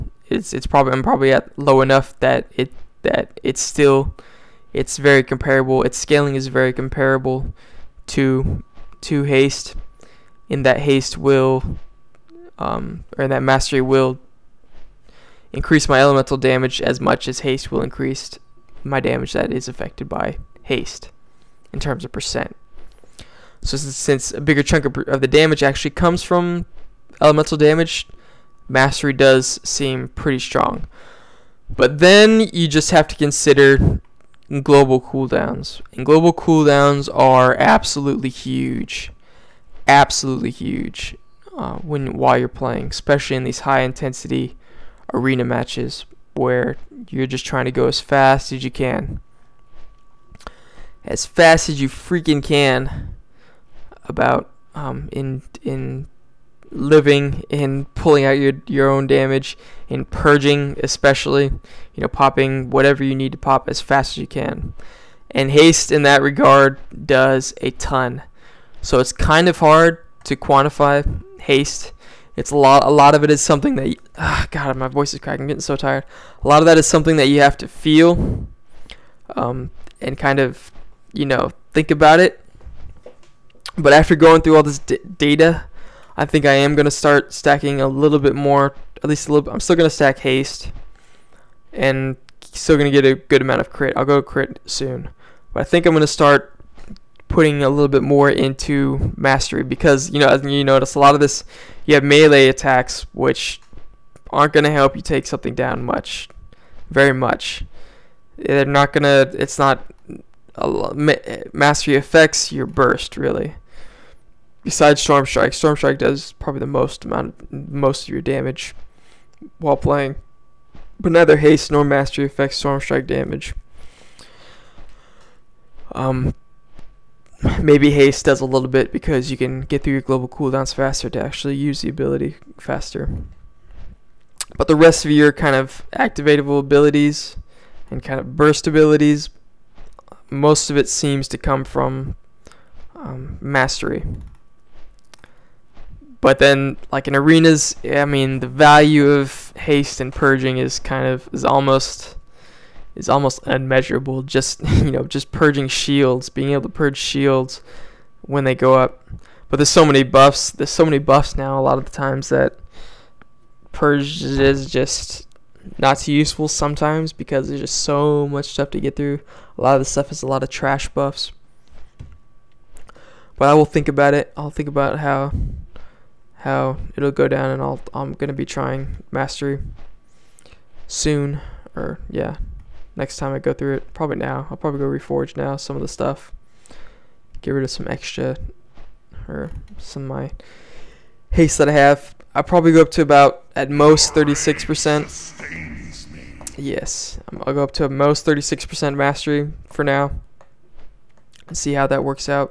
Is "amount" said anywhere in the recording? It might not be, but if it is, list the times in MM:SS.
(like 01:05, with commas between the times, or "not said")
01:33, 01:57.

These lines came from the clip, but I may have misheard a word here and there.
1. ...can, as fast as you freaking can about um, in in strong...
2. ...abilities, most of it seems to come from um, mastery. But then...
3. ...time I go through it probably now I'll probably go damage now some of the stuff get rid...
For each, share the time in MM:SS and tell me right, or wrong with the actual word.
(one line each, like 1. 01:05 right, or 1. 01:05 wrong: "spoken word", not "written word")
1. 00:48 wrong: "living", not "strong"
2. 02:18 right
3. 03:03 wrong: "reforge", not "damage".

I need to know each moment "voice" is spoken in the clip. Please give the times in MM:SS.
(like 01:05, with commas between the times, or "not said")
01:14.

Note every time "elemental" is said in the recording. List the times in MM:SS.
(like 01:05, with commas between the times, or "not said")
00:15, 00:27.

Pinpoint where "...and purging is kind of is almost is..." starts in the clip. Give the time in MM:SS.
02:29.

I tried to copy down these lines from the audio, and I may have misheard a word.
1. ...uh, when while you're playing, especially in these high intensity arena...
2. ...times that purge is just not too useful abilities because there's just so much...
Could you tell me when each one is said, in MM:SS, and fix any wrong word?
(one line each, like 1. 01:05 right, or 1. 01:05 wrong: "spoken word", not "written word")
1. 00:41 right
2. 02:41 wrong: "sometimes", not "abilities".